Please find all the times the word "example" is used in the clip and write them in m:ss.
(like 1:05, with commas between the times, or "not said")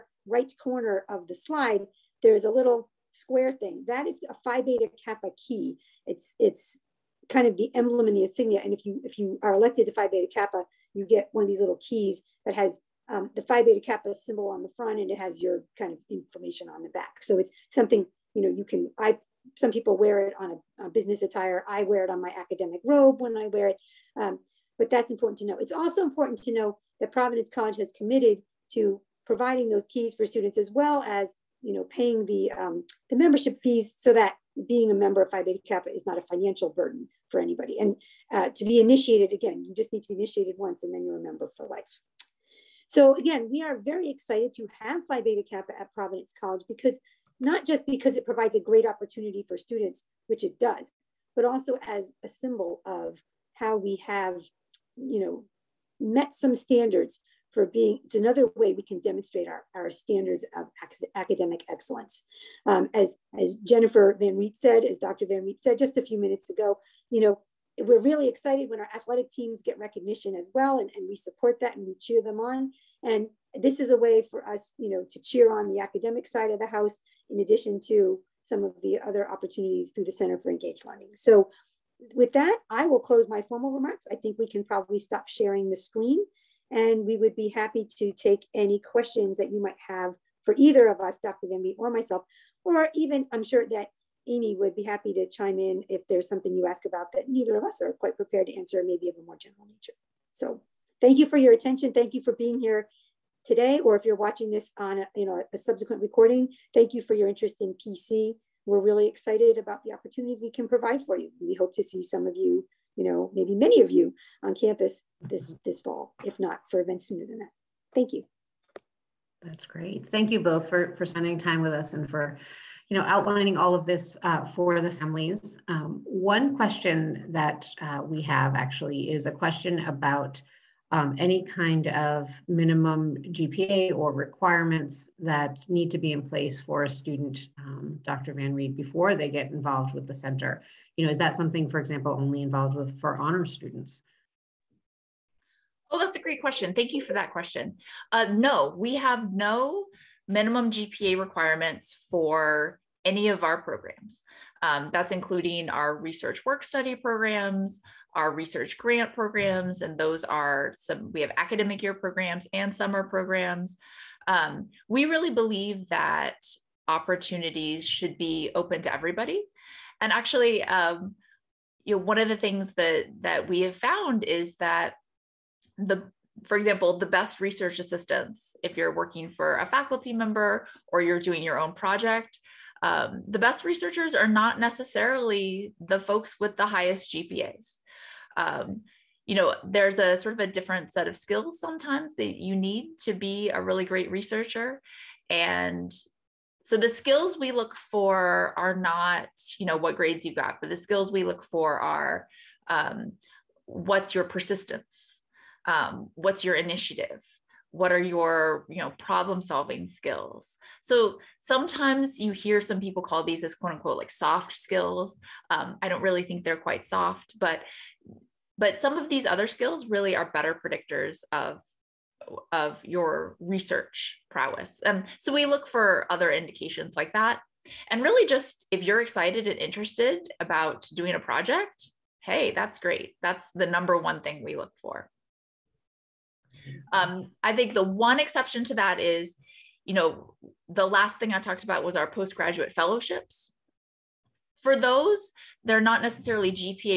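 2:21, 2:56.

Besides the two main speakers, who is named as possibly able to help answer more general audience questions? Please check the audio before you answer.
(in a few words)
Amy.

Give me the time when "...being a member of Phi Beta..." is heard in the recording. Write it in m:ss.
0:34.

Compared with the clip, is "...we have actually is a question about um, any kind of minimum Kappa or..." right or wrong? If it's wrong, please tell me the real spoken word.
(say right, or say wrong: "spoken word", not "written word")
wrong: "GPA", not "Kappa".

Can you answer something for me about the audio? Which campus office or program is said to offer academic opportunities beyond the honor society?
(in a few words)
Center for Engaged Learning.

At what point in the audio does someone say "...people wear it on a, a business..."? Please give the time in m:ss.
0:19.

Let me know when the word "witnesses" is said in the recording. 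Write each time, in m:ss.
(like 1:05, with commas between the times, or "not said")
not said.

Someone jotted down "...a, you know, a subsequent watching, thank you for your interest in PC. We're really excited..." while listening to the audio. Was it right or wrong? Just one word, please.
wrong.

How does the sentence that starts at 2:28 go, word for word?
Uh, no, we have no minimum GPA requirements for any of our programs.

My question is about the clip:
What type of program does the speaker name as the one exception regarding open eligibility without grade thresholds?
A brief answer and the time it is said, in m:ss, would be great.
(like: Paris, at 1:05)
Postgraduate fellowships, at 4:02.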